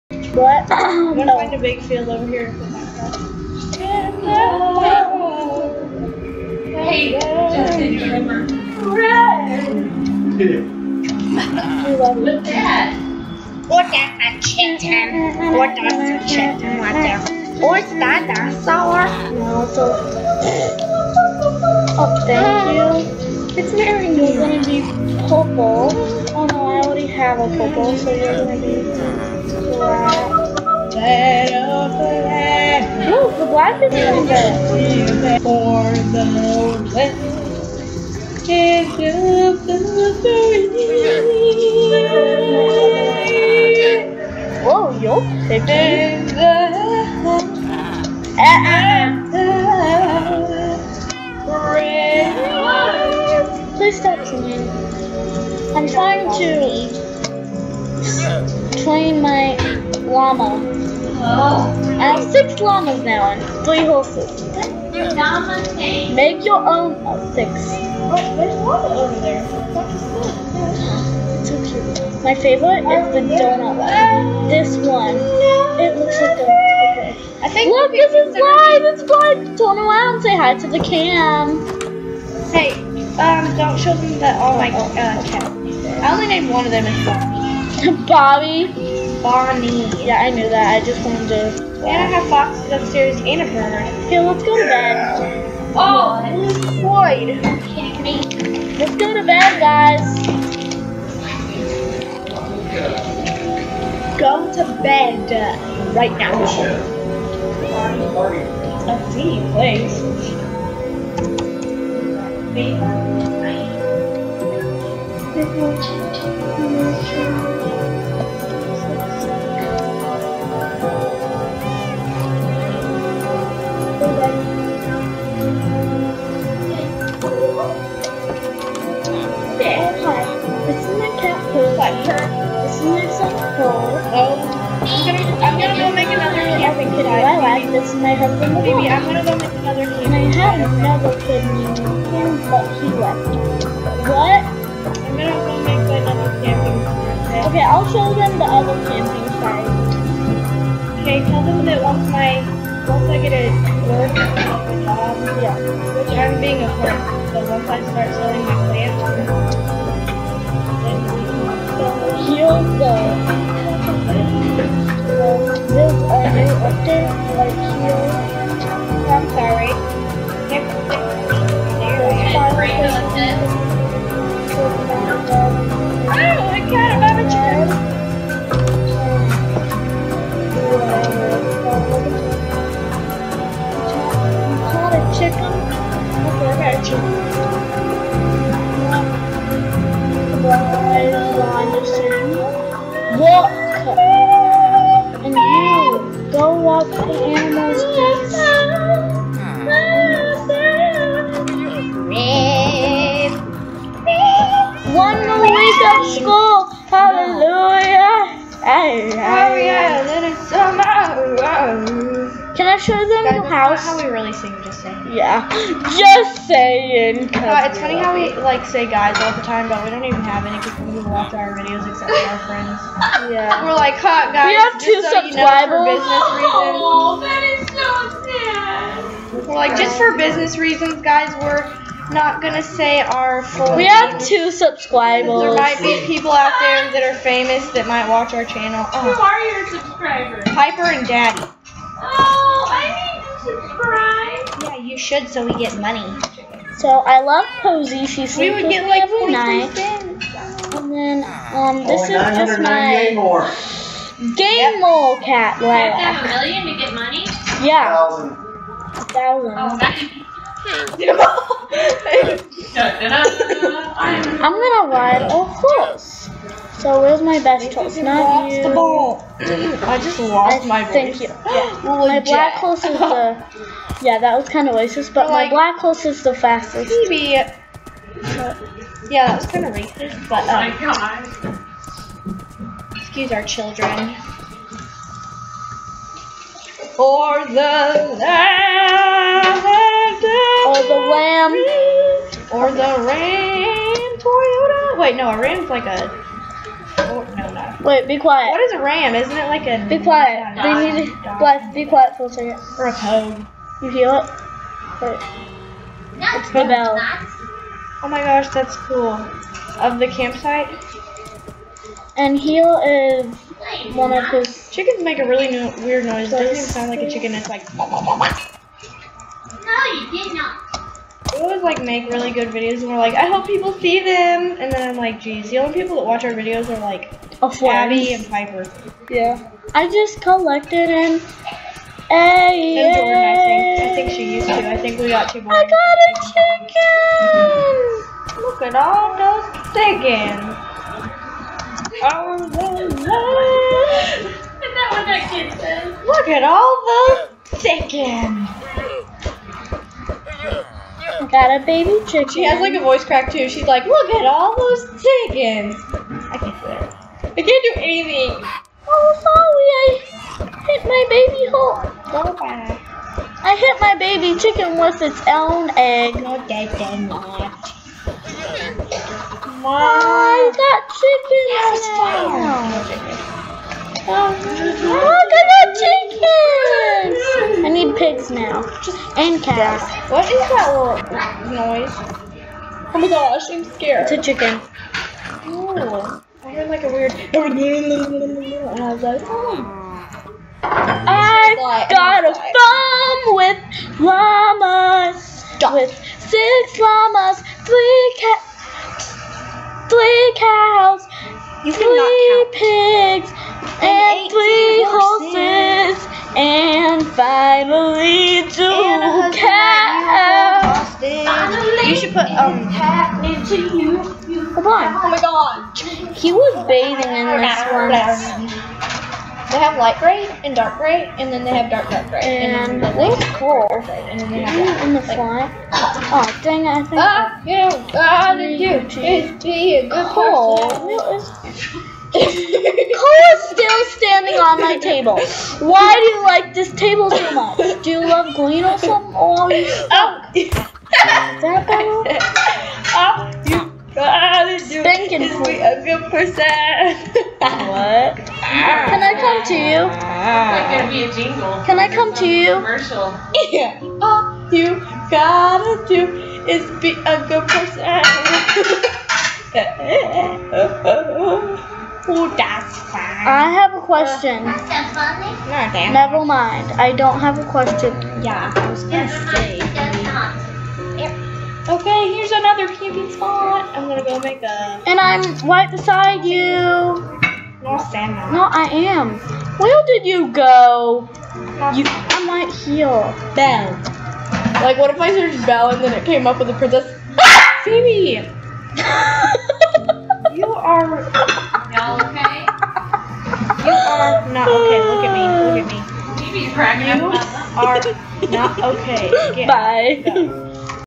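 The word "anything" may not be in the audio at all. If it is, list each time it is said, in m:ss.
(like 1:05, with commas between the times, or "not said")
5:57.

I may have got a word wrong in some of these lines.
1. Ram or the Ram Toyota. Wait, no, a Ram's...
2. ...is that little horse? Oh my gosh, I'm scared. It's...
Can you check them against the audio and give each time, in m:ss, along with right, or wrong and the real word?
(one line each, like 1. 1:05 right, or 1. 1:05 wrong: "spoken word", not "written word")
1. 4:51 right
2. 6:20 wrong: "noise", not "horse".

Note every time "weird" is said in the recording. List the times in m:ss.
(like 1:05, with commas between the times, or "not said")
5:15, 6:26.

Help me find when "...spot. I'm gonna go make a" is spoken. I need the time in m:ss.
7:53.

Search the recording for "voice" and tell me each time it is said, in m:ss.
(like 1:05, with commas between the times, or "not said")
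4:30, 5:52.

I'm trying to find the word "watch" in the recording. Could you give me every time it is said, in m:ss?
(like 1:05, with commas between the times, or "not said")
3:41, 3:58, 5:26.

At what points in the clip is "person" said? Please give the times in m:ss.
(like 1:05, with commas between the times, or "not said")
7:10, 7:26, 7:37.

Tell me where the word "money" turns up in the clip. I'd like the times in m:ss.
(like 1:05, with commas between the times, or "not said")
4:05, 4:16.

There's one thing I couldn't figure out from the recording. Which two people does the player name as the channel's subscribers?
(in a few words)
Piper and Daddy.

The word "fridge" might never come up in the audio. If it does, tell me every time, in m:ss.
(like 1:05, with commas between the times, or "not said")
not said.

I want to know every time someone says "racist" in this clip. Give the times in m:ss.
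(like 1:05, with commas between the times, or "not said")
4:34, 4:39.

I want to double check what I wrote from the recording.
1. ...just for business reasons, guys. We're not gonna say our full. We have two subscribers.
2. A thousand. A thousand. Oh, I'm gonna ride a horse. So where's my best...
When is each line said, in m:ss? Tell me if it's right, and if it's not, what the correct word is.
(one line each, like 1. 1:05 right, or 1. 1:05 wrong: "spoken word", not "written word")
1. 3:49 right
2. 4:18 right.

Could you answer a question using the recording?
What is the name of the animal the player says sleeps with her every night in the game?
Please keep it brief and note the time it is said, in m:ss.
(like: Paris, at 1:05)
Posy, at 4:07.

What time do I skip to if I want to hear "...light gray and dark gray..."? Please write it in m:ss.
6:59.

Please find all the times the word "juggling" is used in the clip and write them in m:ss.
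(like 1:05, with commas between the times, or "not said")
not said.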